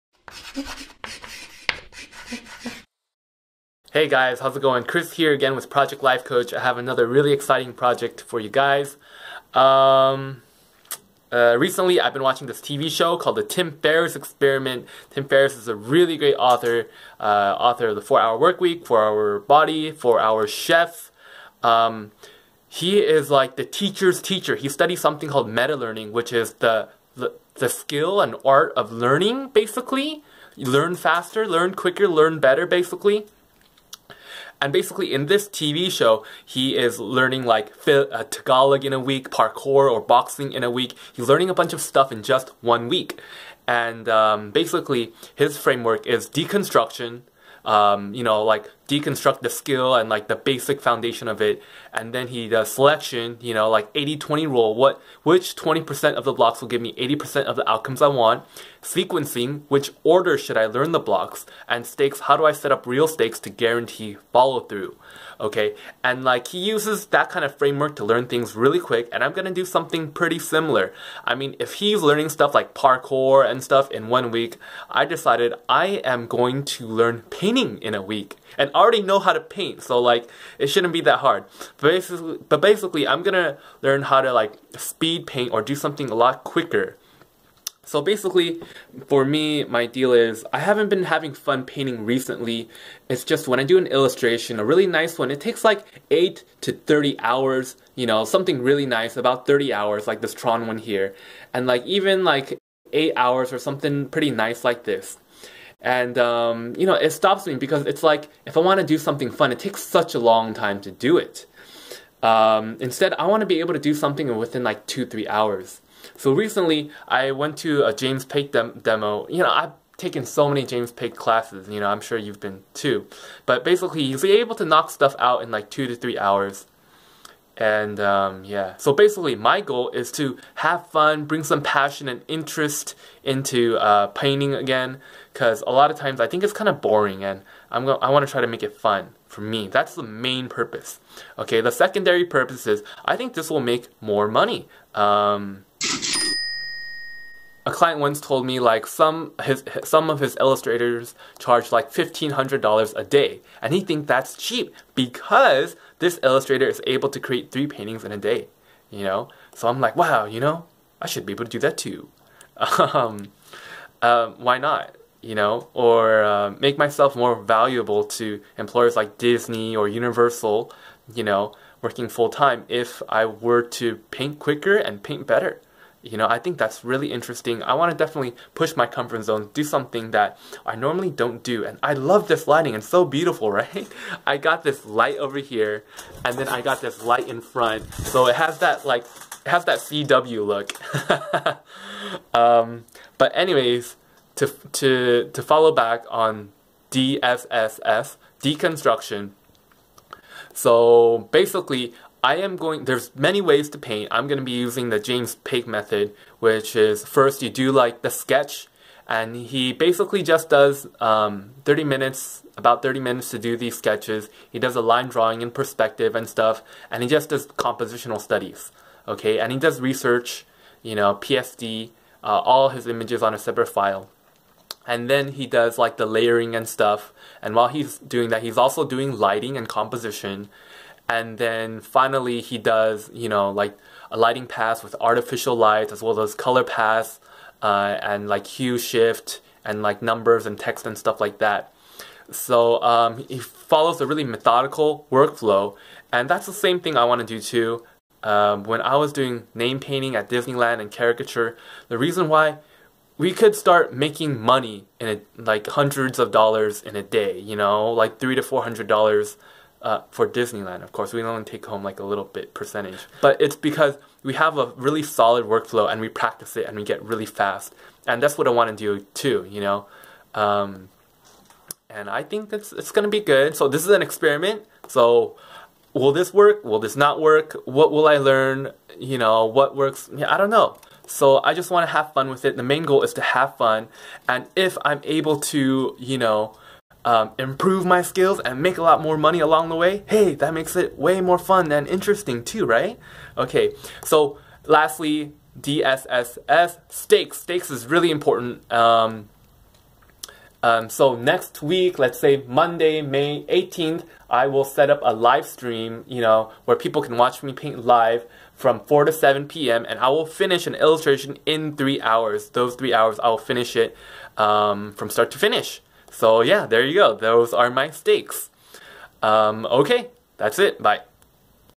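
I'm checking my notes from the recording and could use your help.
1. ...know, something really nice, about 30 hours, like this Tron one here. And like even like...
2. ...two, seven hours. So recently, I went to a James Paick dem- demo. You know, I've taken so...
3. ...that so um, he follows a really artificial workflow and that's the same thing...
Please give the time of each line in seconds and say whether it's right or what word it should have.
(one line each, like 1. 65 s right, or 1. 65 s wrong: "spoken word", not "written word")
1. 98 s right
2. 114 s wrong: "three", not "seven"
3. 241 s wrong: "methodical", not "artificial".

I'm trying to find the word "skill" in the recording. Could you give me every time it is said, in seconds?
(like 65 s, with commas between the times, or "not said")
27 s, 49 s, 288 s.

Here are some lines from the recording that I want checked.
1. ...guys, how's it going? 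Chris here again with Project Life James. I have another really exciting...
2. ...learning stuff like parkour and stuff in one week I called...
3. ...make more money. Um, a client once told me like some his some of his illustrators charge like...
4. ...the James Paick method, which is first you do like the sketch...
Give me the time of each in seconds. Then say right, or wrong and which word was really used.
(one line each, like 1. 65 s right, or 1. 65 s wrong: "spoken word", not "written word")
1. 4 s wrong: "Coach", not "James"
2. 72 s wrong: "decided", not "called"
3. 143 s right
4. 204 s right.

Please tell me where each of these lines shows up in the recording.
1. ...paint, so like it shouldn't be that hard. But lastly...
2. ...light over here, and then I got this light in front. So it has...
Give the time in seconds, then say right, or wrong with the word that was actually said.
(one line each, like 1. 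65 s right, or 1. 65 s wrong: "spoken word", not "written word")
1. 79 s wrong: "basically", not "lastly"
2. 184 s right.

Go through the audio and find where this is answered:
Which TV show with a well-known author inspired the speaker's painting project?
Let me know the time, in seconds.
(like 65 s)
13 s.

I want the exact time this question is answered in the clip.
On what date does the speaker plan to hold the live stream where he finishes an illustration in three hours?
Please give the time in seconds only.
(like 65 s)
302 s.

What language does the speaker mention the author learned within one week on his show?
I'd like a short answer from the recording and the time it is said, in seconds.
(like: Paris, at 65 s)
Tagalog, at 38 s.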